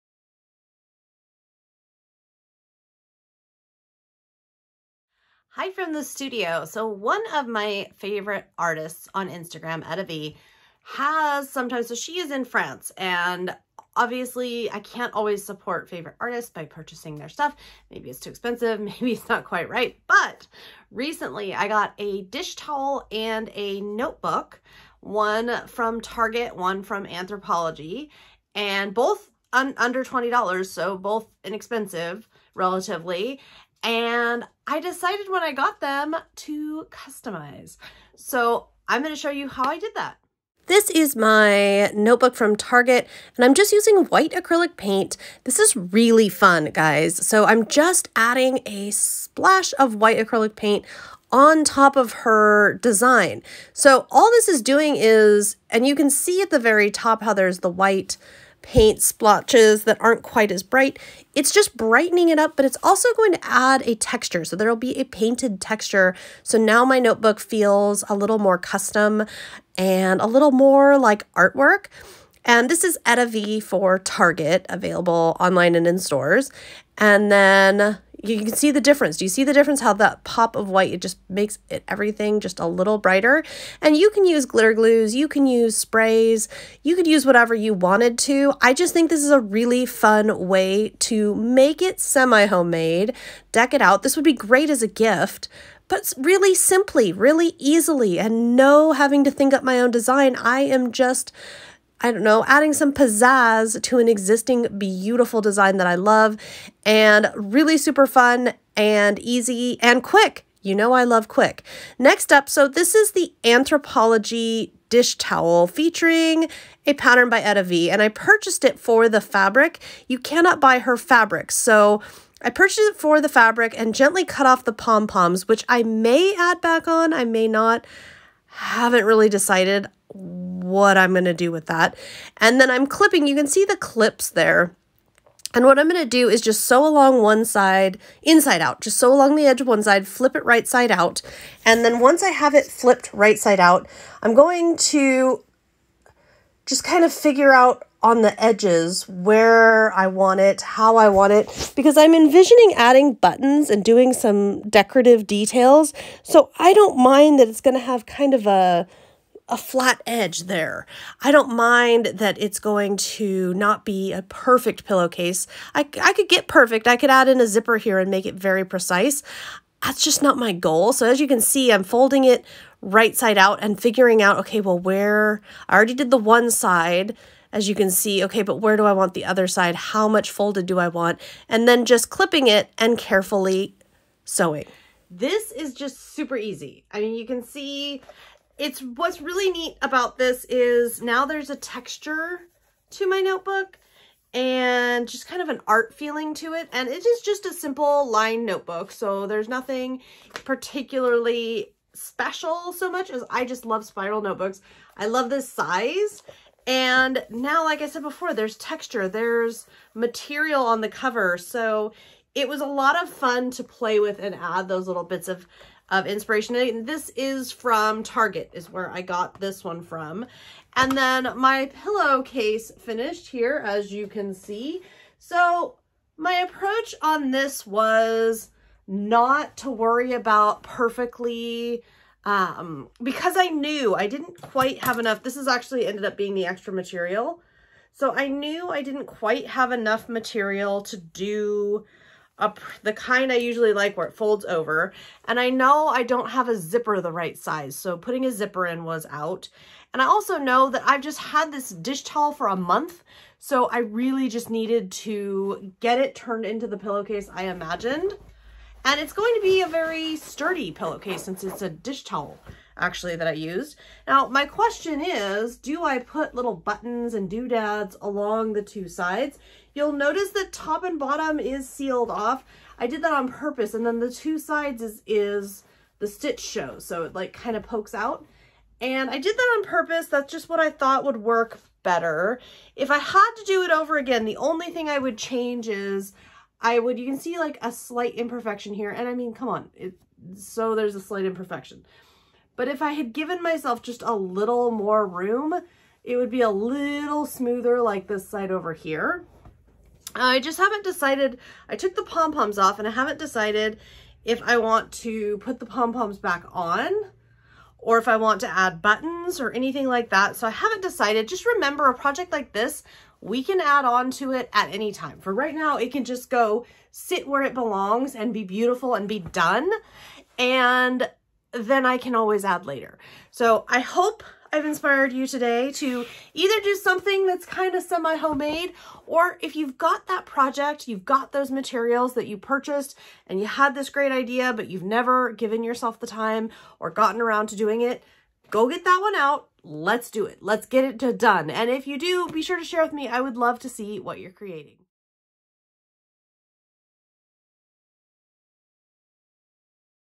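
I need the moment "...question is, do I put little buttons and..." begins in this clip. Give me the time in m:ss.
4:24.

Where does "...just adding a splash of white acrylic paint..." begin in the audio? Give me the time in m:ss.
0:47.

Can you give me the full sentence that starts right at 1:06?
So now my notebook feels a little more custom and a little more like artwork.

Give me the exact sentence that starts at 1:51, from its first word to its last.
Next up, so this is the Anthropologie dish towel featuring a pattern by EttaVee and I purchased it for the fabric.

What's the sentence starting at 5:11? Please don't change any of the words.
Just remember a project like this, we can add on to it at any time.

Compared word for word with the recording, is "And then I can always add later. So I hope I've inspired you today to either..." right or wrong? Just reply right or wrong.
right.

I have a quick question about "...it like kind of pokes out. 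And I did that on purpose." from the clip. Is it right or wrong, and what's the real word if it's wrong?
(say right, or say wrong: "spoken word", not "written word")
right.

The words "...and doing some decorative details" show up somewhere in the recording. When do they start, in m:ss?
2:33.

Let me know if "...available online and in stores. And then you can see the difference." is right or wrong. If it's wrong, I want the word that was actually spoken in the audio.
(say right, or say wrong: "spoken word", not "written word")
right.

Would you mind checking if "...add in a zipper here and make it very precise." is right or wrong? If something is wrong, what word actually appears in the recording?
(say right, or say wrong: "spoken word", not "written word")
right.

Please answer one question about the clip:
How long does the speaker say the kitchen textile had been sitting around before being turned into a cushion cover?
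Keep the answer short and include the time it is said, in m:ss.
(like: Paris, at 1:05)
a month, at 4:12.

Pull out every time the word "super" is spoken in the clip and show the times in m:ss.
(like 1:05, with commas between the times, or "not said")
1:47, 3:06.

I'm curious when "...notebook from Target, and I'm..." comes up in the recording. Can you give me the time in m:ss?
0:41.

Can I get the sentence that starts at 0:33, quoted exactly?
And I decided when I got them to customize.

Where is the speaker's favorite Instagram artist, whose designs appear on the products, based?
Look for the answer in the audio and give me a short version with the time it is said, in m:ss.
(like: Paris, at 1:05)
France, at 0:12.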